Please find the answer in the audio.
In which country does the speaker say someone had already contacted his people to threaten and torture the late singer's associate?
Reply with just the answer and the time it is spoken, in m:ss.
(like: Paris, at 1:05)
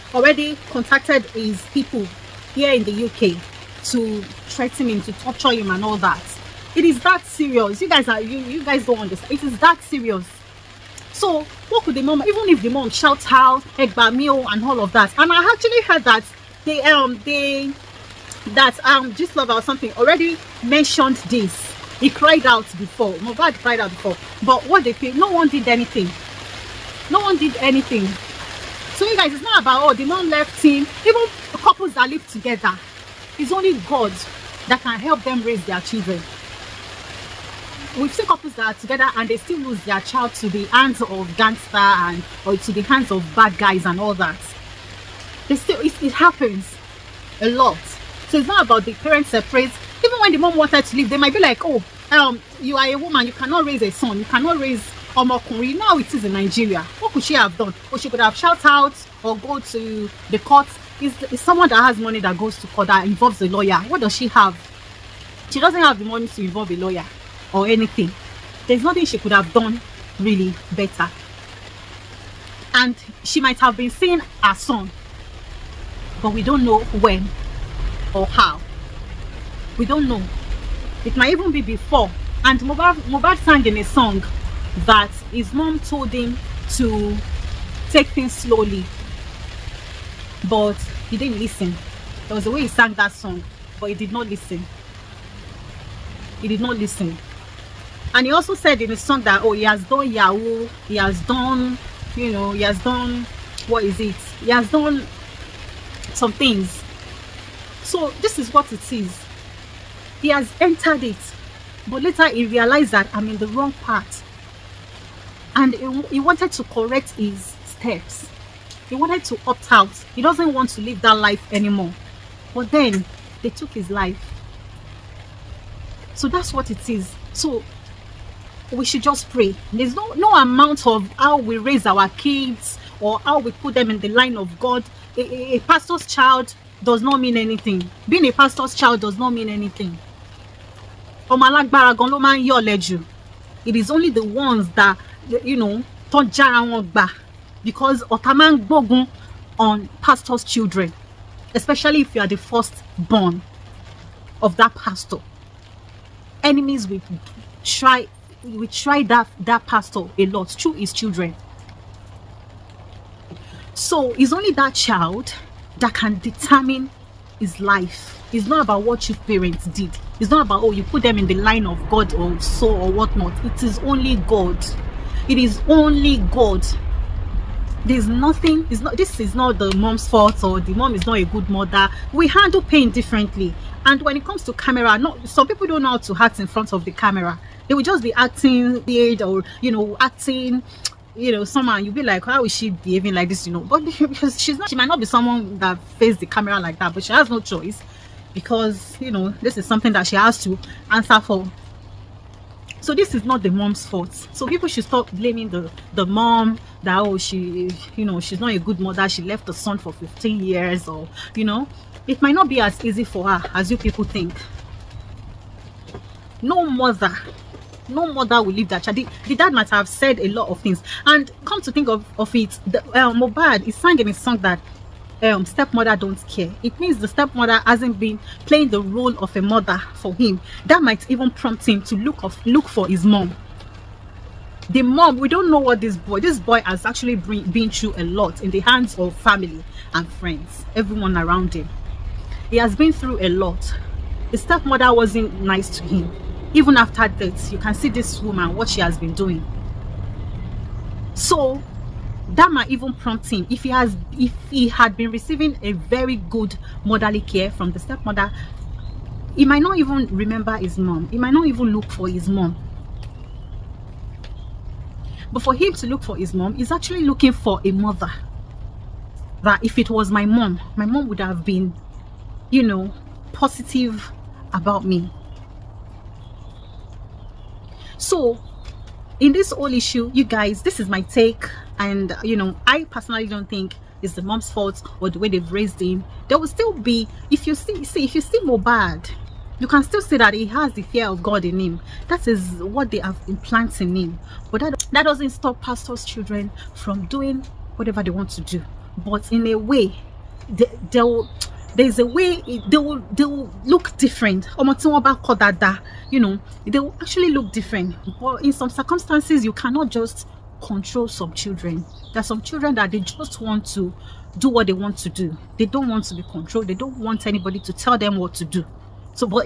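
UK, at 0:03.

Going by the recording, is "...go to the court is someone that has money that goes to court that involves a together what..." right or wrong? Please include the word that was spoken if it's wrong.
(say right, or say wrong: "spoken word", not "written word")
wrong: "lawyer", not "together".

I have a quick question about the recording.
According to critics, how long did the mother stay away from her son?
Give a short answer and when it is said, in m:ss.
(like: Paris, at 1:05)
15 years, at 3:29.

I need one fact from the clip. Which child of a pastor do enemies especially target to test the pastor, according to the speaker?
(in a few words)
The first born.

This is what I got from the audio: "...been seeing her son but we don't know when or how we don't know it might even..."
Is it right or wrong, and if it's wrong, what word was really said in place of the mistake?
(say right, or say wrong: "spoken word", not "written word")
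right.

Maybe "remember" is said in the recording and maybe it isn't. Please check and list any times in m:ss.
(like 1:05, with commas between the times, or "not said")
4:20.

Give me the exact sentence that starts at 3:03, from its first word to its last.
And when it comes to camera, not some people don't know how to act in front of the camera.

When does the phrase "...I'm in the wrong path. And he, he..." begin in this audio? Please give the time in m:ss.
1:53.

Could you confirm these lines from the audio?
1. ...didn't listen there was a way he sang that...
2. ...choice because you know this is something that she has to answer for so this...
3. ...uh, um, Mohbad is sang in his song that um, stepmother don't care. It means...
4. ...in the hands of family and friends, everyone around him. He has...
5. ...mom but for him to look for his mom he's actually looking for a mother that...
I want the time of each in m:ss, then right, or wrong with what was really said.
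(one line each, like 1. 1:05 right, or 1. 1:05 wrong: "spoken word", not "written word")
1. 1:31 right
2. 3:17 right
3. 3:42 right
4. 3:58 right
5. 4:22 right.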